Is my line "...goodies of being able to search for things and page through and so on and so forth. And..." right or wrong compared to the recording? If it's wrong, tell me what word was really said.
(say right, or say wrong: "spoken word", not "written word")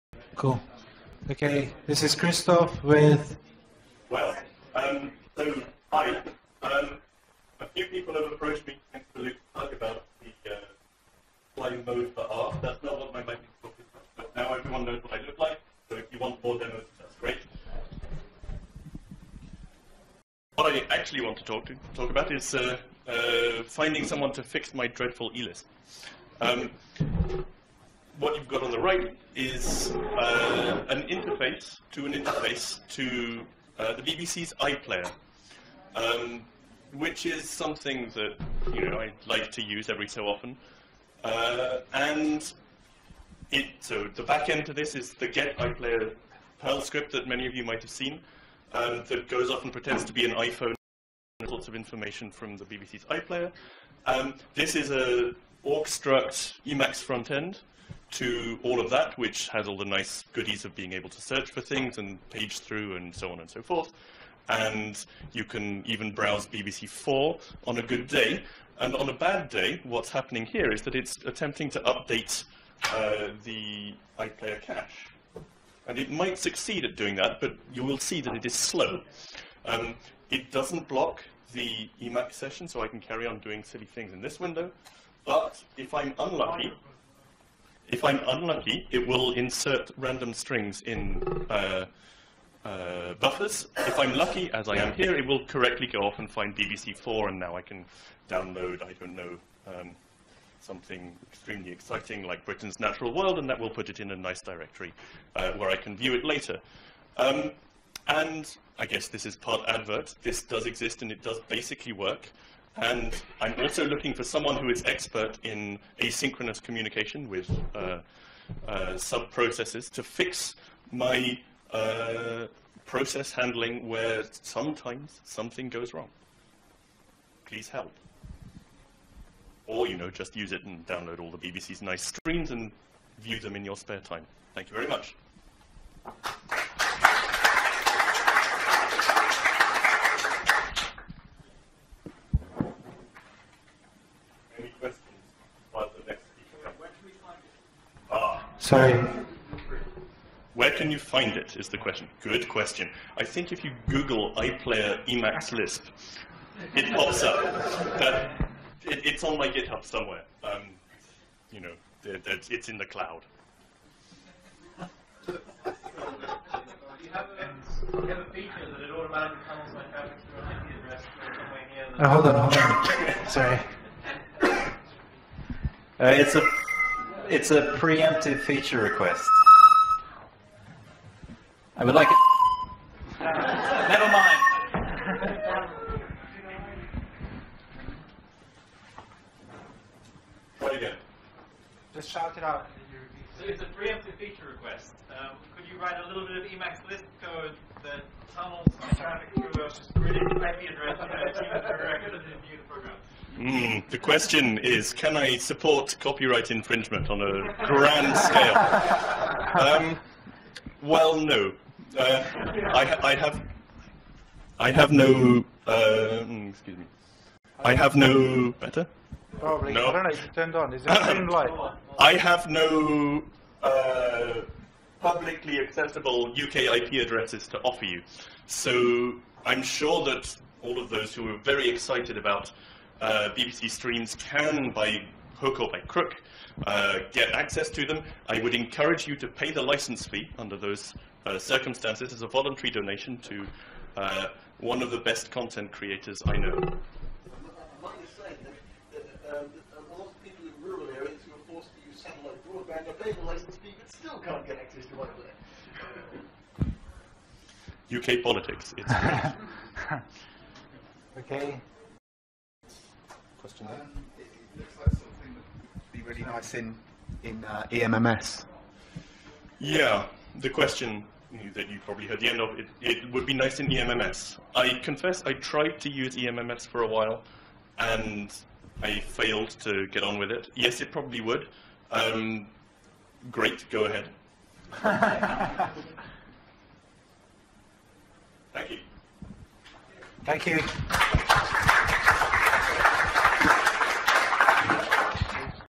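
right.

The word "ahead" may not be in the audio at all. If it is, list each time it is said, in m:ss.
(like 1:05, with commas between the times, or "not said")
4:43.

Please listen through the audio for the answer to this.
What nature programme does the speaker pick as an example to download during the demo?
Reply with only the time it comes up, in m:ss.
1:42.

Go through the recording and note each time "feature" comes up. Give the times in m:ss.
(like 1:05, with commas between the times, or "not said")
2:58, 3:14.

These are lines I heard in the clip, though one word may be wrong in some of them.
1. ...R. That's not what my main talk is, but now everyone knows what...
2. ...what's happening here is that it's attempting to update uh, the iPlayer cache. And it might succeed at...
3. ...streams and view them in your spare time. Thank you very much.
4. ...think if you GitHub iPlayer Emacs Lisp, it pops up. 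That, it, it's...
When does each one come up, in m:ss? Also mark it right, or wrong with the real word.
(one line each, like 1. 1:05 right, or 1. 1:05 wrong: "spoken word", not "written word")
1. 0:12 right
2. 1:09 right
3. 2:12 right
4. 2:33 wrong: "Google", not "GitHub".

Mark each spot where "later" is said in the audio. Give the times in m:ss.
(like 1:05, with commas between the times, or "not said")
1:46.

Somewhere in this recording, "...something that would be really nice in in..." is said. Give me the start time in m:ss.
4:24.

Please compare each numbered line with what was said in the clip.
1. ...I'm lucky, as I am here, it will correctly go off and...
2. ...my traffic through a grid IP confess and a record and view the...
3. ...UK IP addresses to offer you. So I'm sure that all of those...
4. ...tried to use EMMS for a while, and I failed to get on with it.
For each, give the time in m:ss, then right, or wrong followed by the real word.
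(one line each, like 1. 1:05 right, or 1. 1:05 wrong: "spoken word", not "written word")
1. 1:33 right
2. 3:18 wrong: "address", not "confess"
3. 3:46 right
4. 4:35 right.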